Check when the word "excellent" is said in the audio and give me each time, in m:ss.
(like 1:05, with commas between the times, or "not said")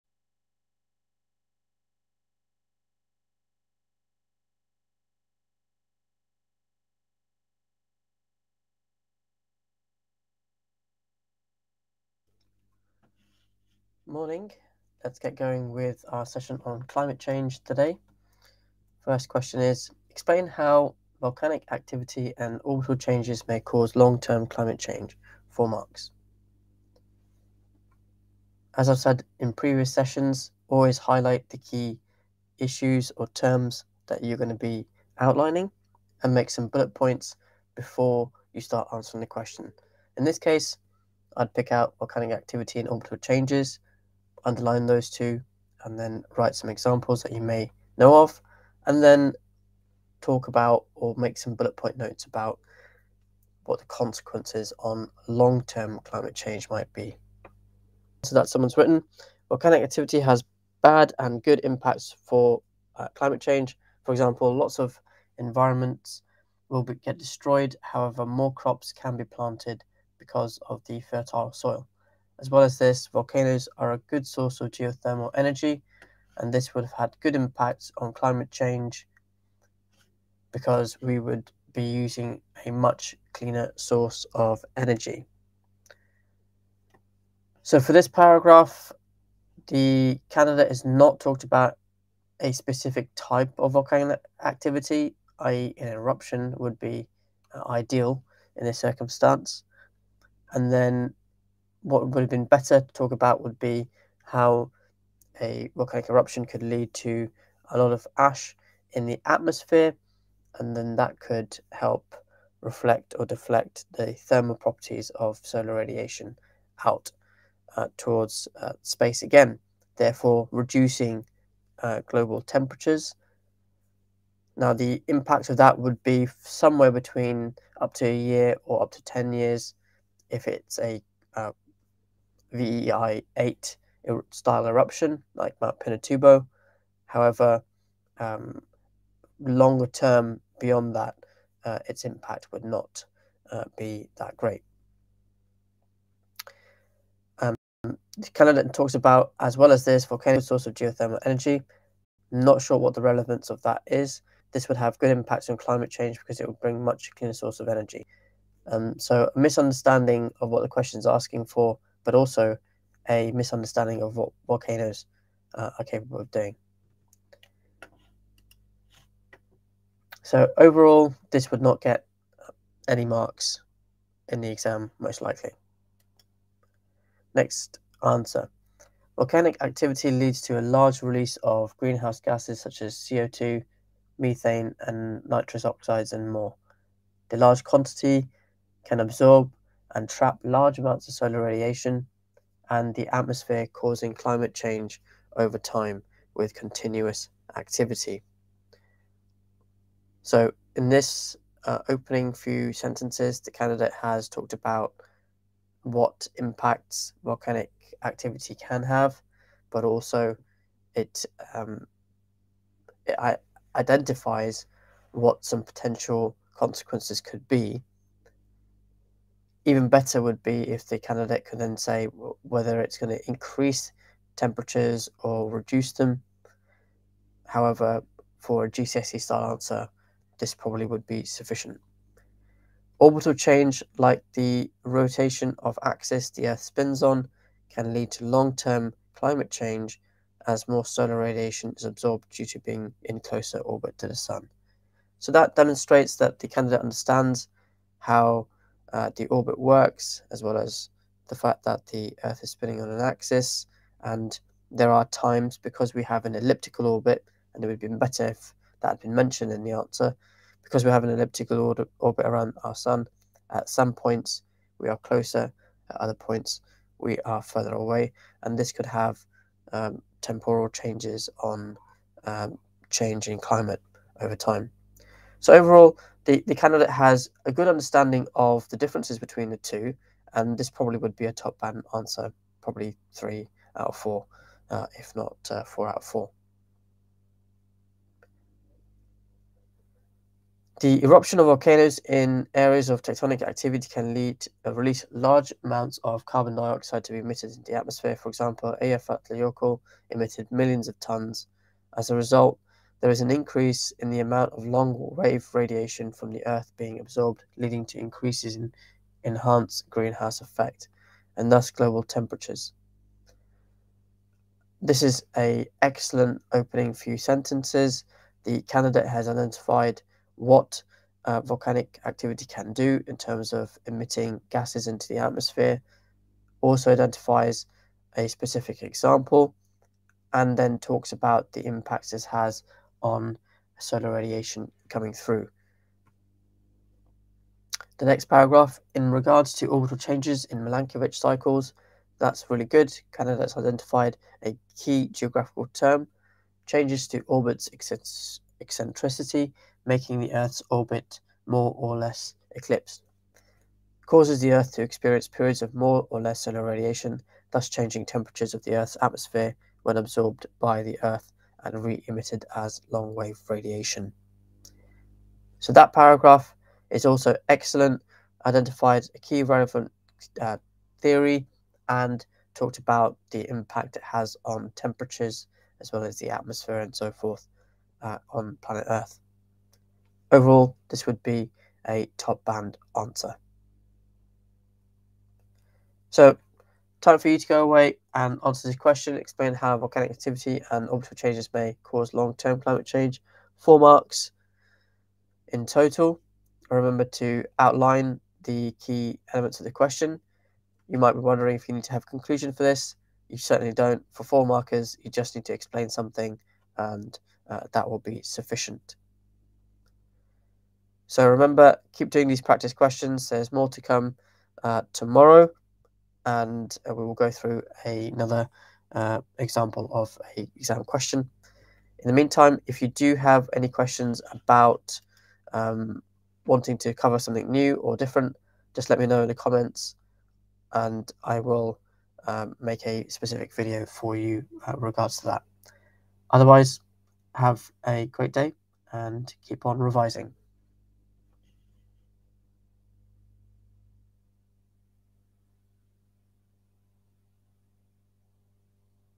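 5:15, 6:07.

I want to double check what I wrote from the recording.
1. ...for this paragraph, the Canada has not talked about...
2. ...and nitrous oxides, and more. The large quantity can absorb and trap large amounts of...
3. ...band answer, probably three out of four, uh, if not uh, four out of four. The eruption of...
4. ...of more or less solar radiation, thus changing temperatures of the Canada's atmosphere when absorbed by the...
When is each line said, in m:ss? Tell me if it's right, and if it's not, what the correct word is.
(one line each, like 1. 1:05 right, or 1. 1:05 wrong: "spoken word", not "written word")
1. 1:27 right
2. 3:04 right
3. 4:41 right
4. 5:55 wrong: "Earth", not "Canada".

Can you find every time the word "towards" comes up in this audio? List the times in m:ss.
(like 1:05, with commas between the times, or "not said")
1:57.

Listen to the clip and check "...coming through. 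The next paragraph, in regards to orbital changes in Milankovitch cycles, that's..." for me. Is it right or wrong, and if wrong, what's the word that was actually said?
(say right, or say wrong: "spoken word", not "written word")
right.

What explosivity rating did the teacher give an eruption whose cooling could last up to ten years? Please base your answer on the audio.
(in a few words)
VEI8.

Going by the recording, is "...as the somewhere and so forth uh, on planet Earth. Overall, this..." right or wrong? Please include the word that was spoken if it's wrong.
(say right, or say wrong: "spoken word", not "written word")
wrong: "atmosphere", not "somewhere".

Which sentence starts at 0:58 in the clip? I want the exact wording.
So that someone's written volcanic activity has bad and good impacts for uh, climate change.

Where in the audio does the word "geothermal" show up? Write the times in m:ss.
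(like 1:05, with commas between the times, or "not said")
1:14, 2:30.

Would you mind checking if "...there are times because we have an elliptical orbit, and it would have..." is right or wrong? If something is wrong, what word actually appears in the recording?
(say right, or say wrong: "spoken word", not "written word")
right.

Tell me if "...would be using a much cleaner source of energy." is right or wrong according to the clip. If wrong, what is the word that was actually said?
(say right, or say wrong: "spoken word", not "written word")
right.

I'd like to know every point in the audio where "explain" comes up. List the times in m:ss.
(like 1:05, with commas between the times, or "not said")
0:20, 6:29, 6:45.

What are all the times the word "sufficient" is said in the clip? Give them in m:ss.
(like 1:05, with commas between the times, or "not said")
3:51, 6:48.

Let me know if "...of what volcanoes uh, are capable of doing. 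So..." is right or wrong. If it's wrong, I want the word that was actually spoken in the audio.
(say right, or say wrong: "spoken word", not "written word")
right.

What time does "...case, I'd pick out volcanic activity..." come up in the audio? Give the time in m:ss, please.
0:40.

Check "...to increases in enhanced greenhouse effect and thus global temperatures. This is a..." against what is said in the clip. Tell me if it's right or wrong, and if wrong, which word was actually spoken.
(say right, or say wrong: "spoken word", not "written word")
right.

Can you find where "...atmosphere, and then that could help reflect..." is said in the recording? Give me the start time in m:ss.
1:49.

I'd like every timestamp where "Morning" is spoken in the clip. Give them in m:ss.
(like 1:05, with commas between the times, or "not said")
0:14.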